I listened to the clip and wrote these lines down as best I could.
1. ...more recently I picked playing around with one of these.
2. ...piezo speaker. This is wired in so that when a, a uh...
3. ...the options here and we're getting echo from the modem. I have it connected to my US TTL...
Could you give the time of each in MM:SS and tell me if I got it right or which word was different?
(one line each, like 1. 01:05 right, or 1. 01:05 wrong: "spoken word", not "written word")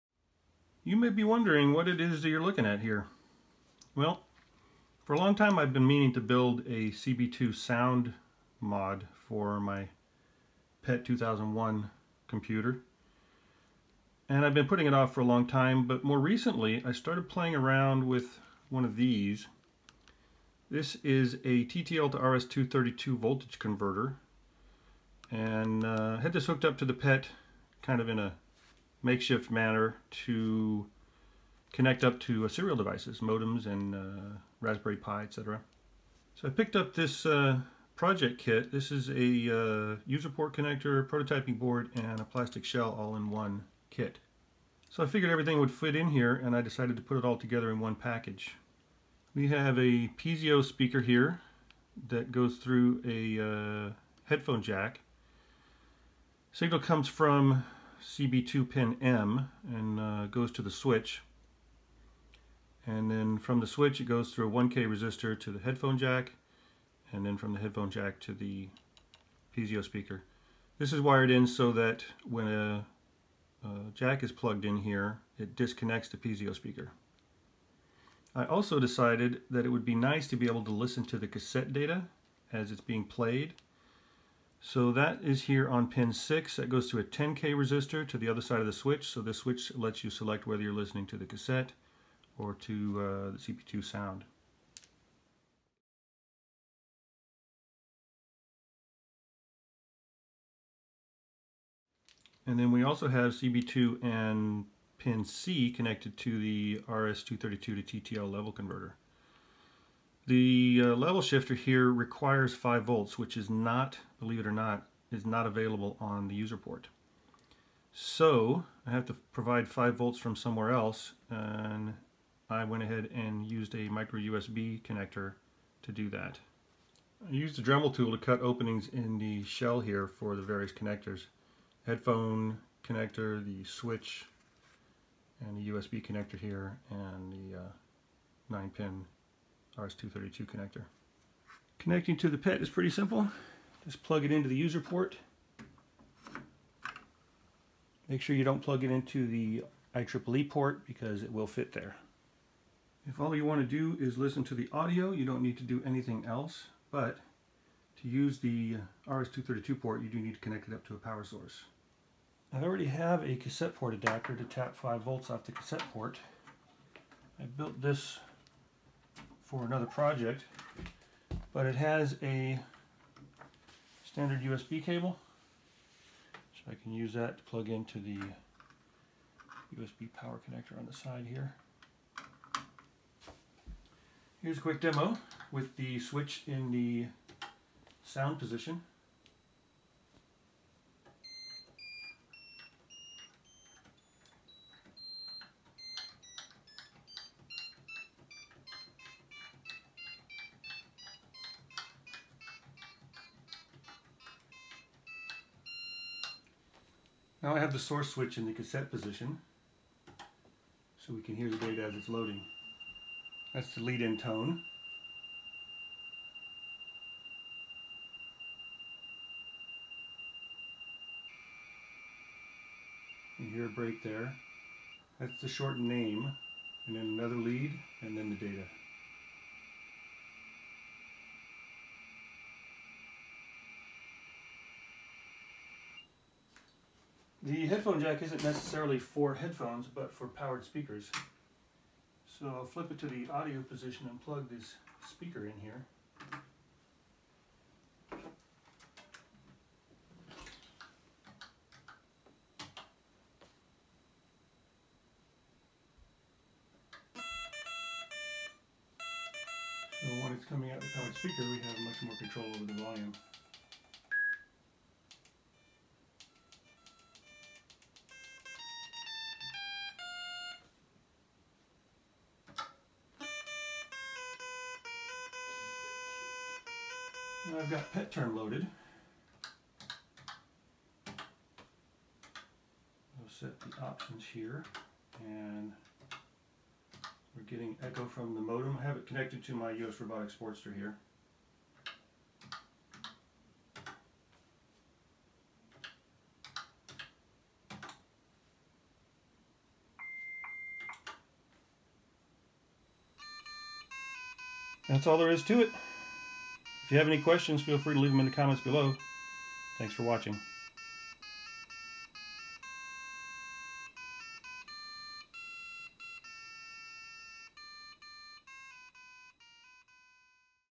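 1. 00:16 wrong: "started", not "picked"
2. 01:09 right
3. 04:43 wrong: "Robotics", not "TTL".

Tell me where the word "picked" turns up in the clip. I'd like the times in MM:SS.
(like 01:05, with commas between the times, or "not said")
00:36.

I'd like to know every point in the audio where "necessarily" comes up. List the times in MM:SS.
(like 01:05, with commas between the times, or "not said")
03:58.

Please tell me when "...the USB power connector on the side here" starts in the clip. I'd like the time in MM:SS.
02:57.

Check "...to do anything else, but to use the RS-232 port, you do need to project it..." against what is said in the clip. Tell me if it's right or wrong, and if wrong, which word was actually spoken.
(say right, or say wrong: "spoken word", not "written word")
wrong: "connect", not "project".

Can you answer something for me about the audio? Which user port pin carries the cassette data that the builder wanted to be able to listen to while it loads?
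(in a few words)
6.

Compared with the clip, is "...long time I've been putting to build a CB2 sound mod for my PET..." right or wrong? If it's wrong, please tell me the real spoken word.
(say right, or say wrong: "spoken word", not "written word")
wrong: "meaning", not "putting".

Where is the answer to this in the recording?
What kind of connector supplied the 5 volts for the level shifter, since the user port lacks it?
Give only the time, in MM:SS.
02:03.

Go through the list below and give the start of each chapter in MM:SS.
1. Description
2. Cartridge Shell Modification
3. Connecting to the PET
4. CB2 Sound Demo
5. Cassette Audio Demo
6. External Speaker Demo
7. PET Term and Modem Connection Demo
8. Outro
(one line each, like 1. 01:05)
1. 00:49
2. 02:07
3. 02:21
4. 03:04
5. 03:27
6. 03:57
7. 04:37
8. 05:03.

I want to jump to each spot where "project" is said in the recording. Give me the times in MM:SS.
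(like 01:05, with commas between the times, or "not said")
00:37, 02:49.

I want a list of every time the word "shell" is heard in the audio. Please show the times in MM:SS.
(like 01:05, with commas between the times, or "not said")
00:42, 02:09.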